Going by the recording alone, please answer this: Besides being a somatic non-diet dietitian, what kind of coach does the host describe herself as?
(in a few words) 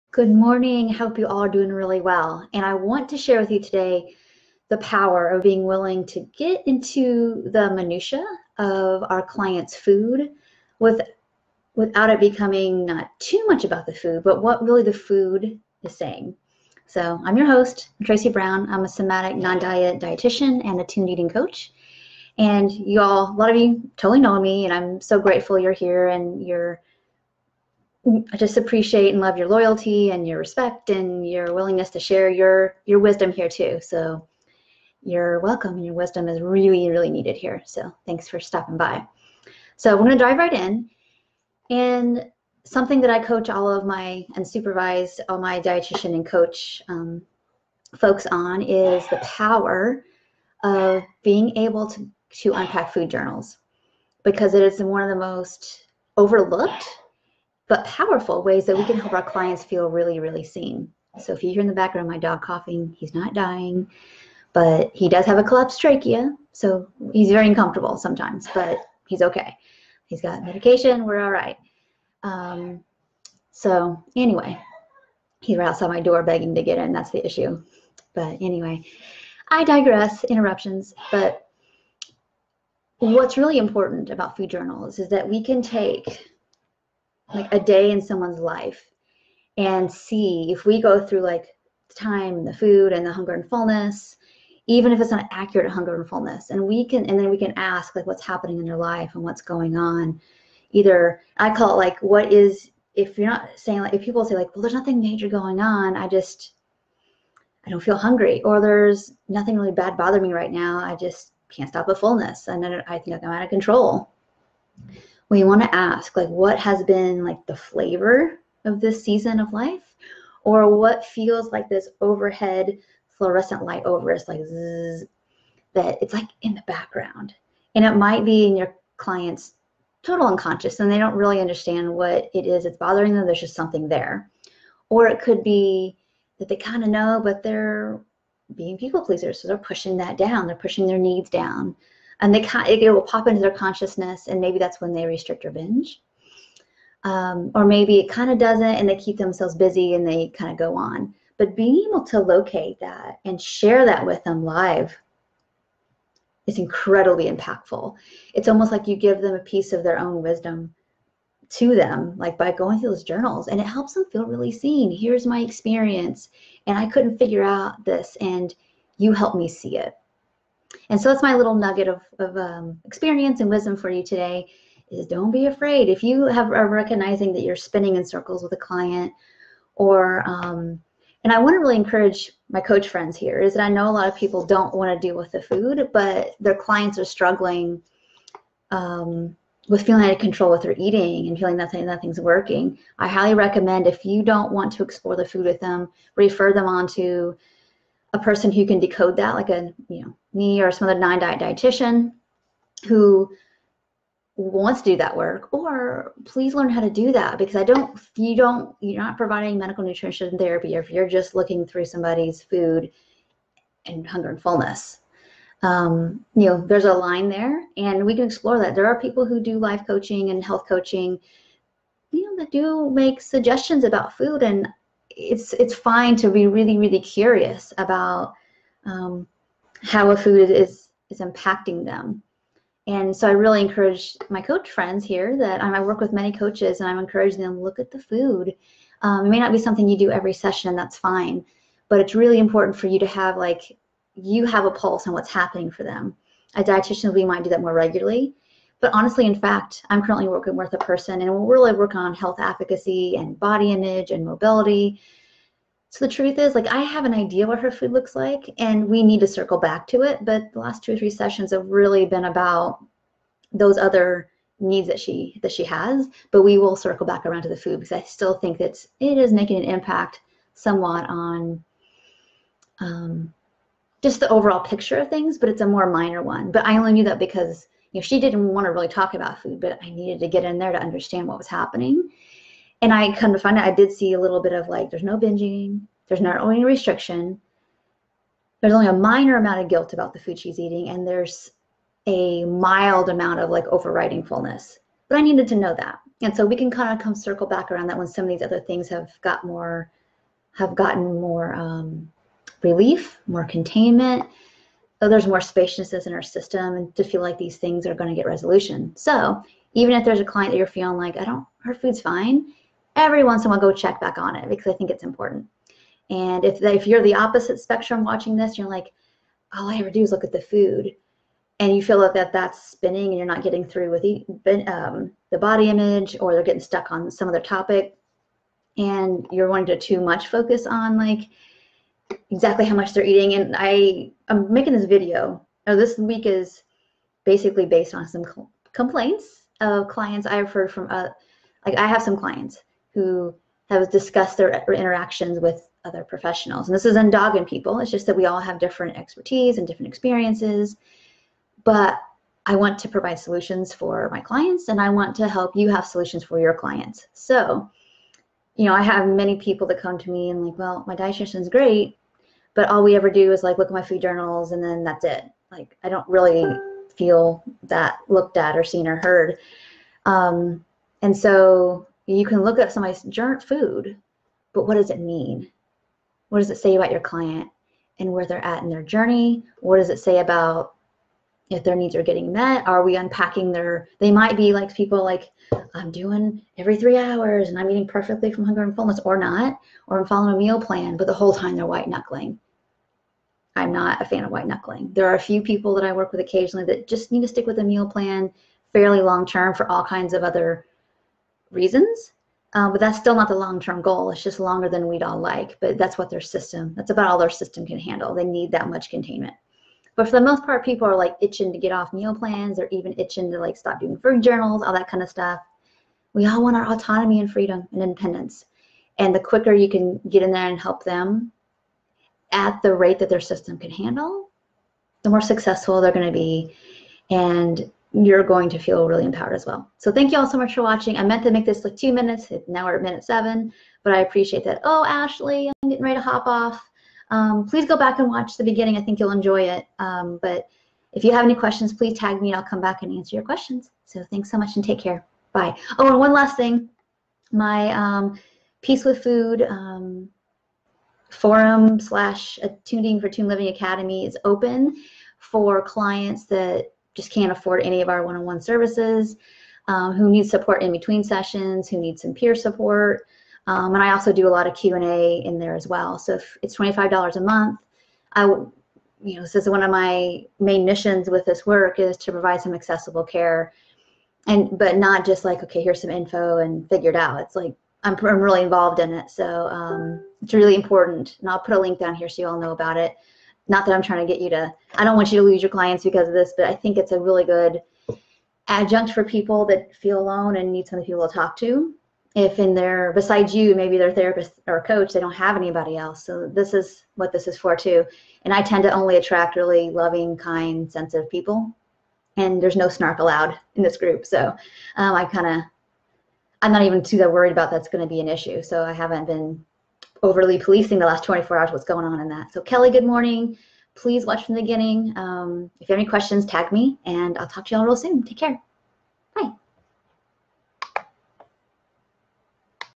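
attuned eating coach.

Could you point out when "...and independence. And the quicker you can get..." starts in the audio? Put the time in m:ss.
6:57.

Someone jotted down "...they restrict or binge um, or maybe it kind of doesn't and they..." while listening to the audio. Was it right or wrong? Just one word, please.
right.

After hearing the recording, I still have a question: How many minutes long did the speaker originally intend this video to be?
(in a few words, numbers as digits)
2.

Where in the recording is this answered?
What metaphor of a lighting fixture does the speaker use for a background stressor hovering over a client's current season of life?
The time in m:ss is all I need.
2:02.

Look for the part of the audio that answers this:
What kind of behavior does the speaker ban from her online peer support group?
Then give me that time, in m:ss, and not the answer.
8:22.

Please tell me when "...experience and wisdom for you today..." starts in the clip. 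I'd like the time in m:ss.
2:52.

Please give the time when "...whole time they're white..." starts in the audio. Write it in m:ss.
6:31.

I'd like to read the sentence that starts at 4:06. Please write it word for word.
A dietitian, we might do that more regularly.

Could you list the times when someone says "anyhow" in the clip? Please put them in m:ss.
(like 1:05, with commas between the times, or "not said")
not said.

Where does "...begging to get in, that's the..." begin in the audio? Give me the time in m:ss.
1:16.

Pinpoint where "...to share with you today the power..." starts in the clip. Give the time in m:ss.
0:03.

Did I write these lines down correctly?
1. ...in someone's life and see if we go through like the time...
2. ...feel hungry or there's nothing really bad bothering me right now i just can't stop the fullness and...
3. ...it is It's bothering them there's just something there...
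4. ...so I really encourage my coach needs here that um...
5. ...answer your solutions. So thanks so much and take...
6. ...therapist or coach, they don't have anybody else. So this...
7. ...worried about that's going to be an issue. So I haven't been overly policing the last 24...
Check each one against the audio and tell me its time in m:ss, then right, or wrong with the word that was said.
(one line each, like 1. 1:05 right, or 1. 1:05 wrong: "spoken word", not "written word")
1. 1:27 right
2. 1:47 right
3. 2:12 right
4. 3:53 wrong: "friends", not "needs"
5. 7:22 wrong: "questions", not "solutions"
6. 8:13 right
7. 8:27 right.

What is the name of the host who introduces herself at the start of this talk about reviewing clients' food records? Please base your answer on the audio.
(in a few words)
Tracy Brown.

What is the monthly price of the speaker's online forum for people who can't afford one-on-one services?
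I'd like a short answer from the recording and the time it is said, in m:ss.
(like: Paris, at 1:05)
$25, at 7:46.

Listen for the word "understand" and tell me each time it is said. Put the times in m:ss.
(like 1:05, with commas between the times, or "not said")
2:11, 4:40.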